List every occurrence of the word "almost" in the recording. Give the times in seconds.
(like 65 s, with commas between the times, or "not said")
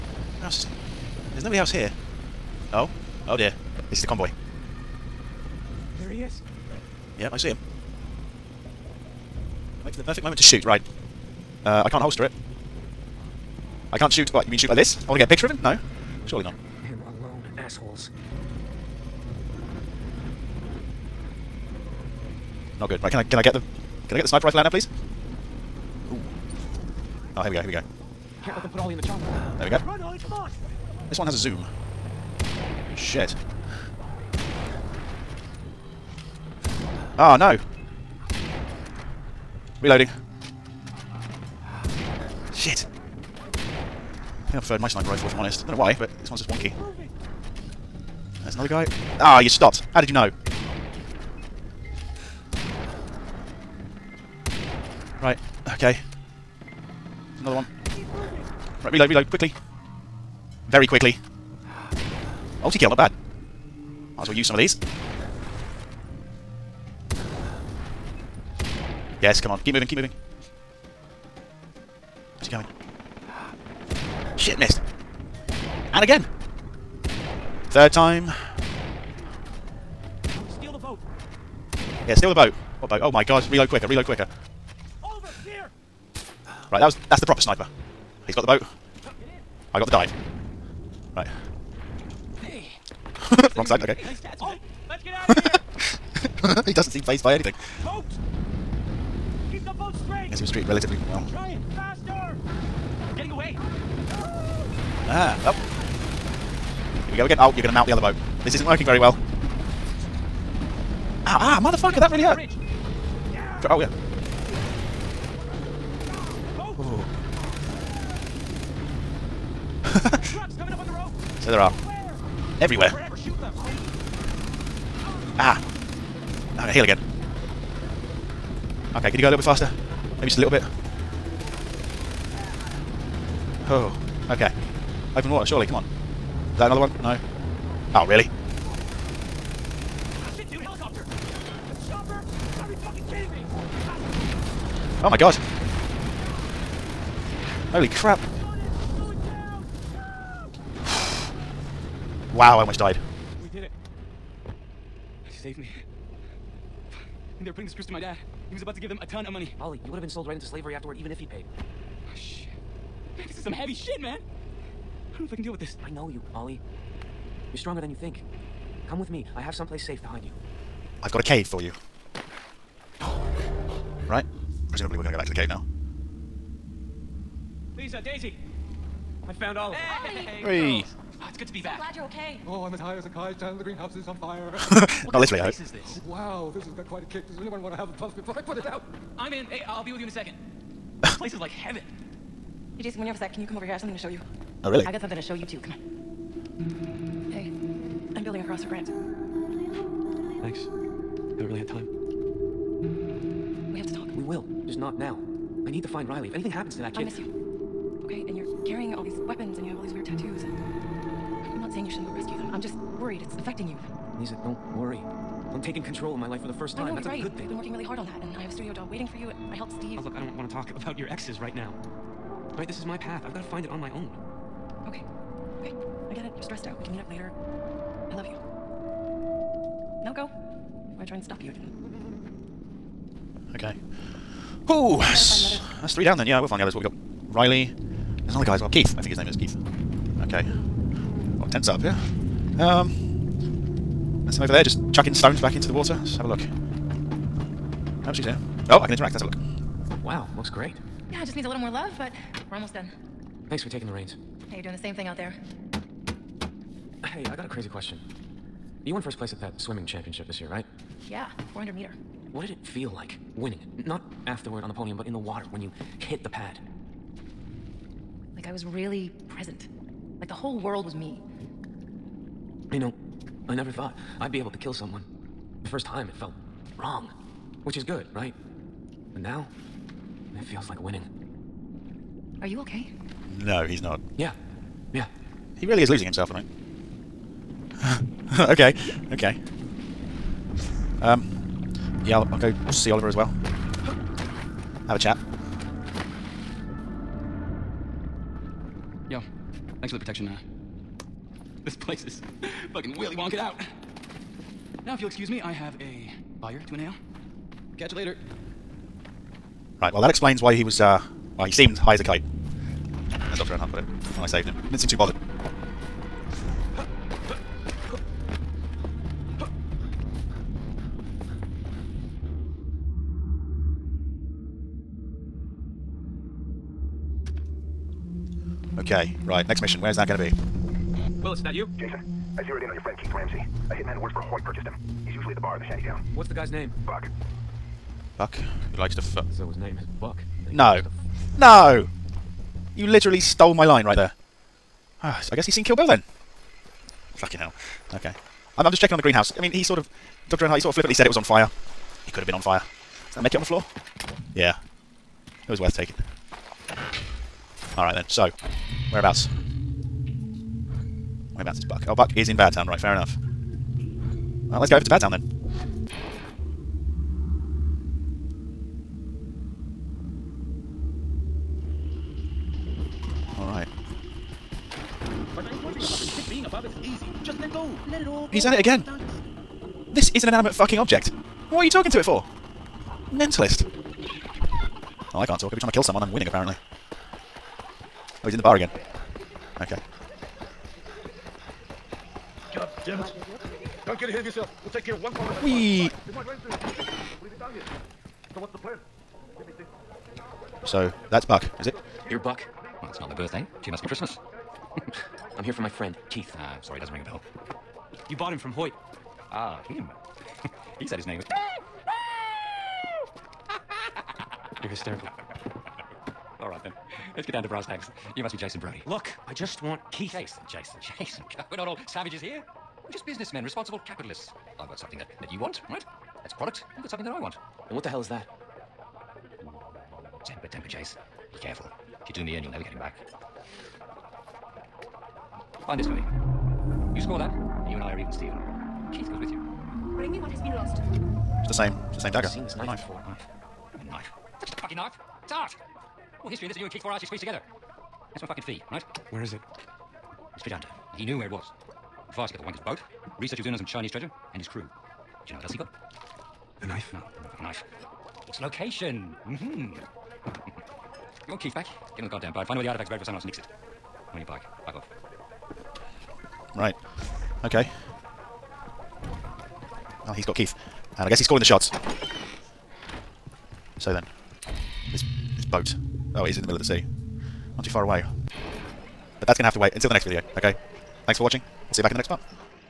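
152 s, 252 s.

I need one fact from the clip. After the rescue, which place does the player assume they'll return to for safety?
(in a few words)
the cave.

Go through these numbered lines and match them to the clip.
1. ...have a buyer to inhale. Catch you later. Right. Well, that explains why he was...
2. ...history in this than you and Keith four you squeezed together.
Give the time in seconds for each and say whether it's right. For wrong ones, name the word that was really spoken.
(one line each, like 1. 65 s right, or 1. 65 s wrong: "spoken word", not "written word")
1. 305 s right
2. 446 s right.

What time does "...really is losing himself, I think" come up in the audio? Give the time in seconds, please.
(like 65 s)
285 s.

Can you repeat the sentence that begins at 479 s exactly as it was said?
But that's going to have to wait until the next video, okay?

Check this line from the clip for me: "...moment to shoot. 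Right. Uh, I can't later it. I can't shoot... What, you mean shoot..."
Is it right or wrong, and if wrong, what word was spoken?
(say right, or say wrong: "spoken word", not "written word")
wrong: "holster", not "later".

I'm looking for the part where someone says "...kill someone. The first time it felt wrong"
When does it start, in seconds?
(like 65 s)
274 s.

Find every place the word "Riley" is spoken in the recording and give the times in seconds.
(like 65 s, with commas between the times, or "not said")
206 s, 237 s.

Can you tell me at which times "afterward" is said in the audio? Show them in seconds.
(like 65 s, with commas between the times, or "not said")
160 s, 264 s.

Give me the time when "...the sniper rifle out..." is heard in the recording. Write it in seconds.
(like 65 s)
24 s.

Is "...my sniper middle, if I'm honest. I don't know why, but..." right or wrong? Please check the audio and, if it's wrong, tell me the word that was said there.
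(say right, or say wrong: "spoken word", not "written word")
wrong: "rifle", not "middle".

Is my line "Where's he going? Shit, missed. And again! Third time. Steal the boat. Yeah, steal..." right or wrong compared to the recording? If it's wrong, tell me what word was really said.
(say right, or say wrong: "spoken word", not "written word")
right.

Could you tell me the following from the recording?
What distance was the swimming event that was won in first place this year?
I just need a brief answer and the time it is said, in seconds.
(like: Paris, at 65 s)
400 meter, at 261 s.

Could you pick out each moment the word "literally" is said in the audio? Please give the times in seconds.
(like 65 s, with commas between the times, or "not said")
185 s, 342 s.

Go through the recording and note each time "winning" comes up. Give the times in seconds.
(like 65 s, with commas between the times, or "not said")
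263 s, 280 s, 386 s.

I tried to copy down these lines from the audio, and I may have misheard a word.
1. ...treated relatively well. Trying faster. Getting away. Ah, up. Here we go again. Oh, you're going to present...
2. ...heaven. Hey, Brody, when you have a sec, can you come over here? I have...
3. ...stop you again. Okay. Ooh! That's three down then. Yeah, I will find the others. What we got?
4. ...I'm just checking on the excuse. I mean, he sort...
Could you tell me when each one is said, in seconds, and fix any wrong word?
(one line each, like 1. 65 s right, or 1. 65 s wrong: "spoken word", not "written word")
1. 100 s wrong: "mount", not "present"
2. 191 s wrong: "Jason", not "Brody"
3. 231 s right
4. 348 s wrong: "greenhouse", not "excuse".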